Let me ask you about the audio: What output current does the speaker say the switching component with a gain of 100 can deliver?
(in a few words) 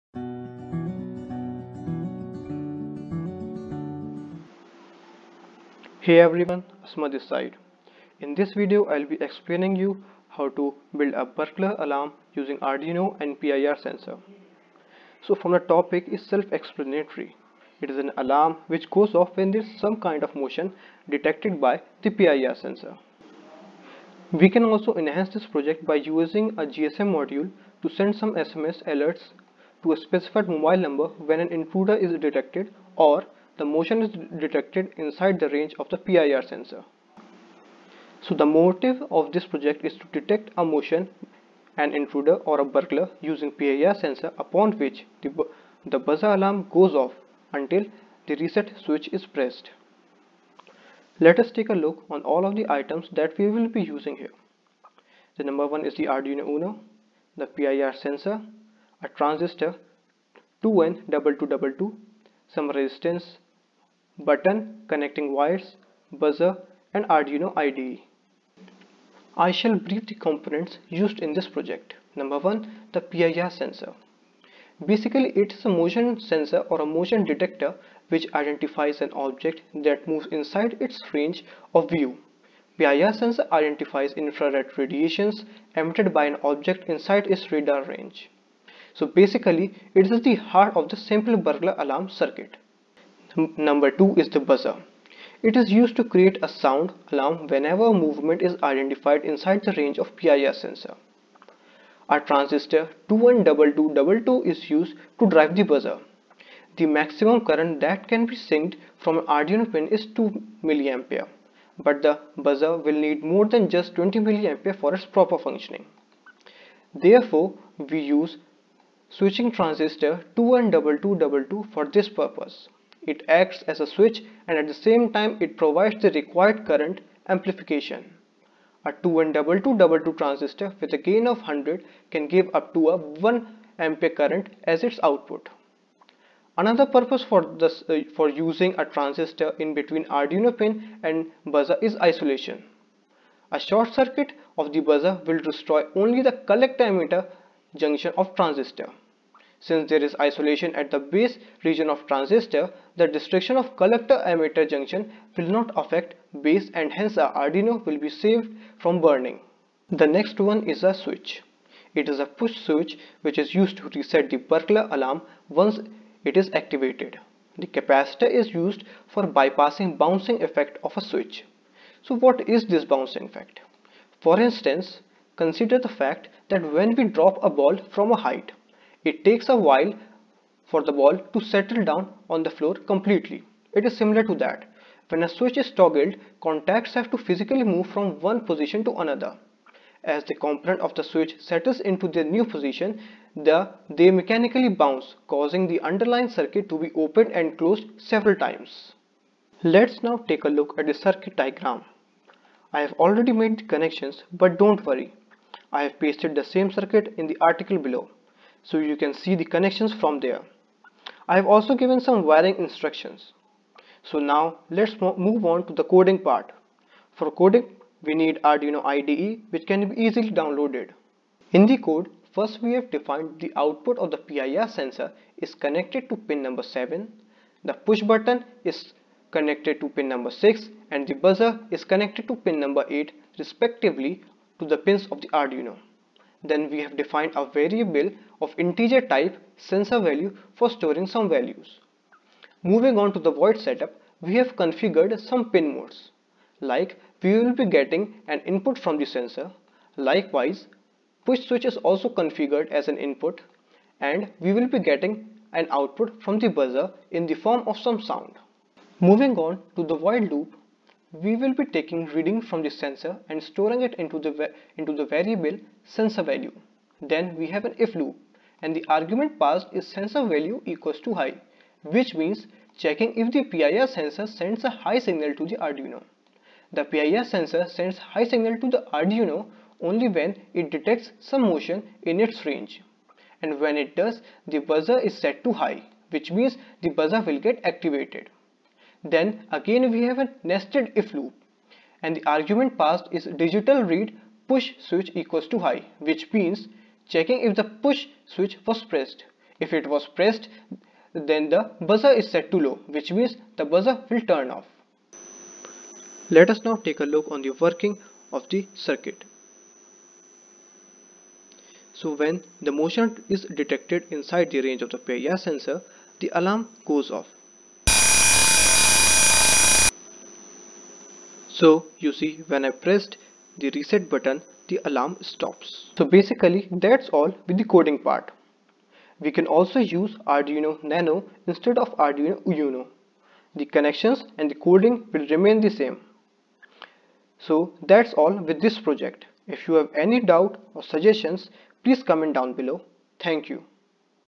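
1 ampere.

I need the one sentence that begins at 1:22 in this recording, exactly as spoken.
PIR sensor identifies infrared radiations emitted by an object inside its radar range.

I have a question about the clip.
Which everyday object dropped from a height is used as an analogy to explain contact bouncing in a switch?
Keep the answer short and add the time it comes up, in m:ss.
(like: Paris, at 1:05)
A ball, at 2:57.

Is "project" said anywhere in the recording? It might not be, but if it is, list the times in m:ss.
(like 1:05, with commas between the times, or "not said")
0:25, 0:39, 1:11, 5:38.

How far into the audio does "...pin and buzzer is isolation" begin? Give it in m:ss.
2:20.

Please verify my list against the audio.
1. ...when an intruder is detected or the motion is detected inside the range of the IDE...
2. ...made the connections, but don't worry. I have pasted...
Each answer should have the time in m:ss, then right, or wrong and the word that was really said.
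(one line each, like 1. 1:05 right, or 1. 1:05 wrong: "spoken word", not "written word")
1. 0:31 wrong: "PIR", not "IDE"
2. 3:23 right.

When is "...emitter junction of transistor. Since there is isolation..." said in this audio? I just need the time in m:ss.
2:26.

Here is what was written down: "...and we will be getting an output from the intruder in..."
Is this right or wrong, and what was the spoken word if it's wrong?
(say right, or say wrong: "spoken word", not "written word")
wrong: "buzzer", not "intruder".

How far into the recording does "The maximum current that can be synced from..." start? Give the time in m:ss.
1:46.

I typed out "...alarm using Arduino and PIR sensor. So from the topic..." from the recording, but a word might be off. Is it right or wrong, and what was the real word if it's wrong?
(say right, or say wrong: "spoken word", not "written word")
right.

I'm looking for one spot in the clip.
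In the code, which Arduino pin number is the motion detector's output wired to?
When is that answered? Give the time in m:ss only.
3:46.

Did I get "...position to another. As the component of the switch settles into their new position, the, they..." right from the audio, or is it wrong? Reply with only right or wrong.
right.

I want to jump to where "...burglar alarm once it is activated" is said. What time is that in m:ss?
2:44.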